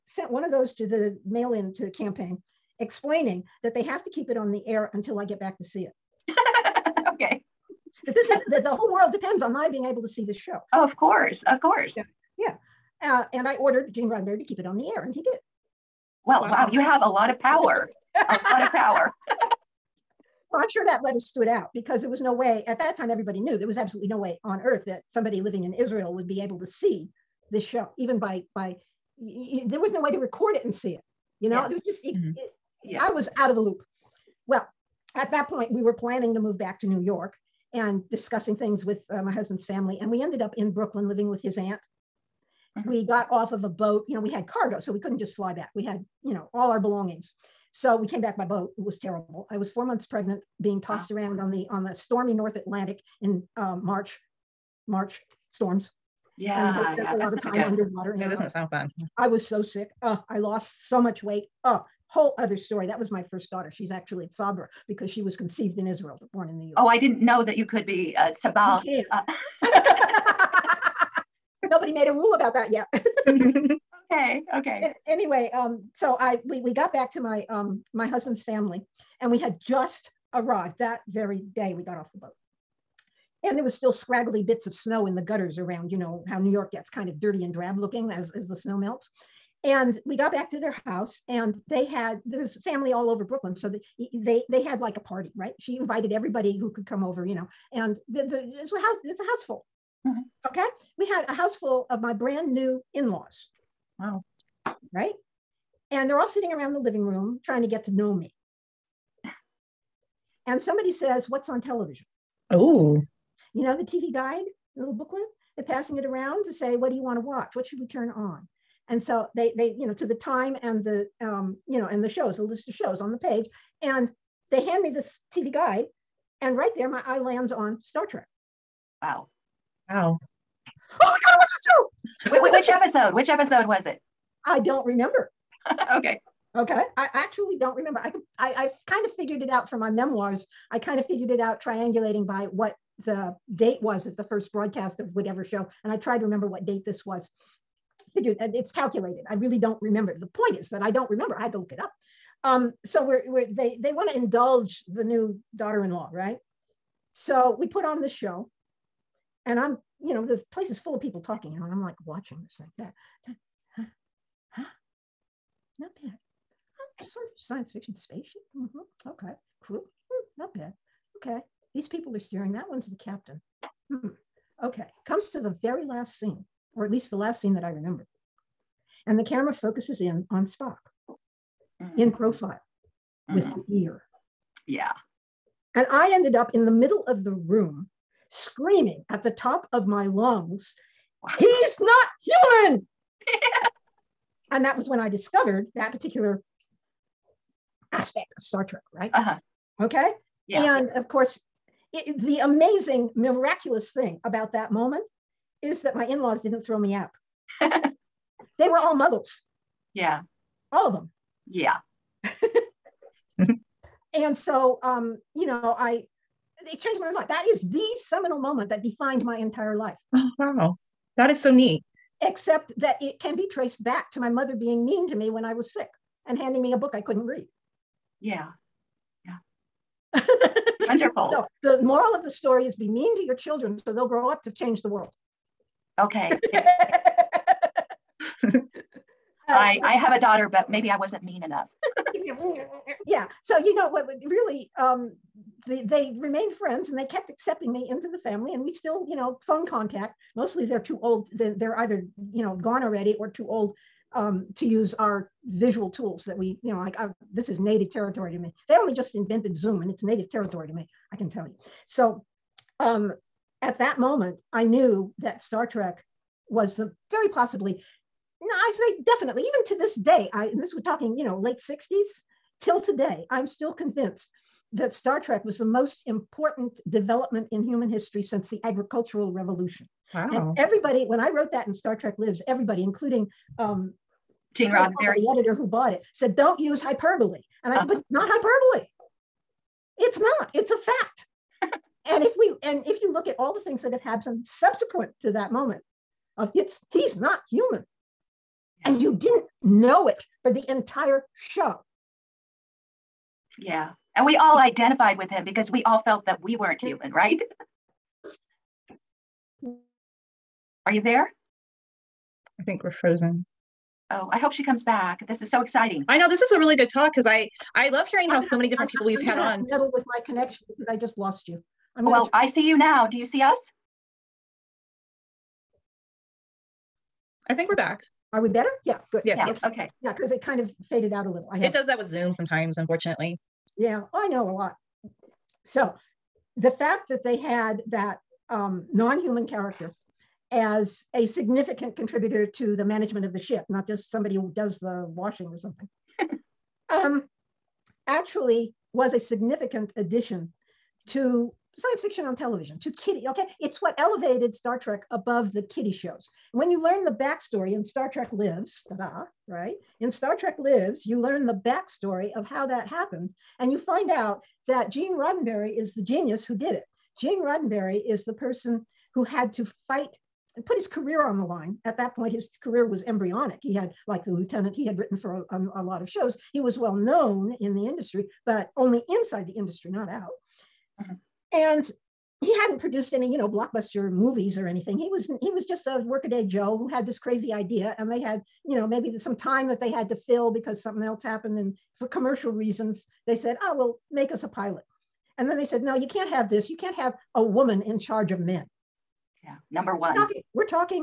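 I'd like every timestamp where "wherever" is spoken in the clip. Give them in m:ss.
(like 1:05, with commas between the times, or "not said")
not said.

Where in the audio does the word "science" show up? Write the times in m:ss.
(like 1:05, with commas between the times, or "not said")
2:47, 5:51.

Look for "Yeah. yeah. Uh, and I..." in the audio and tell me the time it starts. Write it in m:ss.
0:11.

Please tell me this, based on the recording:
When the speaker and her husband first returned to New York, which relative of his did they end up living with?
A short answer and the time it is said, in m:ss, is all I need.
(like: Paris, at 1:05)
His aunt, at 0:41.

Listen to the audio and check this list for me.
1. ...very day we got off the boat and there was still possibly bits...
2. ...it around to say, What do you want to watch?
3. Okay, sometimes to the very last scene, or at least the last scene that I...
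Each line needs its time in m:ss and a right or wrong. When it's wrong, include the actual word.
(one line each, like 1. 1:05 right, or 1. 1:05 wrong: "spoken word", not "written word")
1. 1:21 wrong: "scraggly", not "possibly"
2. 1:55 right
3. 2:54 wrong: "comes", not "sometimes".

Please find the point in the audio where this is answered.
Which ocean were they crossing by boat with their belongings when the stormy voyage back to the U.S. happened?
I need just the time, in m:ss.
0:52.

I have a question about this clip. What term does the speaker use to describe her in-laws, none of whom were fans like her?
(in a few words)
Muggles.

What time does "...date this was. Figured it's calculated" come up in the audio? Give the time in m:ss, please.
2:26.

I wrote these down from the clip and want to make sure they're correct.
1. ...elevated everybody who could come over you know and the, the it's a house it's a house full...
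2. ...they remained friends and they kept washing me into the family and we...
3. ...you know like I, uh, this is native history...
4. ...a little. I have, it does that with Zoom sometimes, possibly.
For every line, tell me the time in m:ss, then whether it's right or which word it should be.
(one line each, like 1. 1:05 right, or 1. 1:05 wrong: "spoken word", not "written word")
1. 1:35 wrong: "invited", not "elevated"
2. 4:05 wrong: "accepting", not "washing"
3. 4:16 wrong: "territory", not "history"
4. 5:31 wrong: "unfortunately", not "possibly".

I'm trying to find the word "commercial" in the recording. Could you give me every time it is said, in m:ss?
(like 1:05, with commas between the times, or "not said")
6:32.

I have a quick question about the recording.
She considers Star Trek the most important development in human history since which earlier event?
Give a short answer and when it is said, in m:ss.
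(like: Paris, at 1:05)
The agricultural revolution, at 4:38.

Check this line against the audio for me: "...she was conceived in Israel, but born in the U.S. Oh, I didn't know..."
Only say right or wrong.
right.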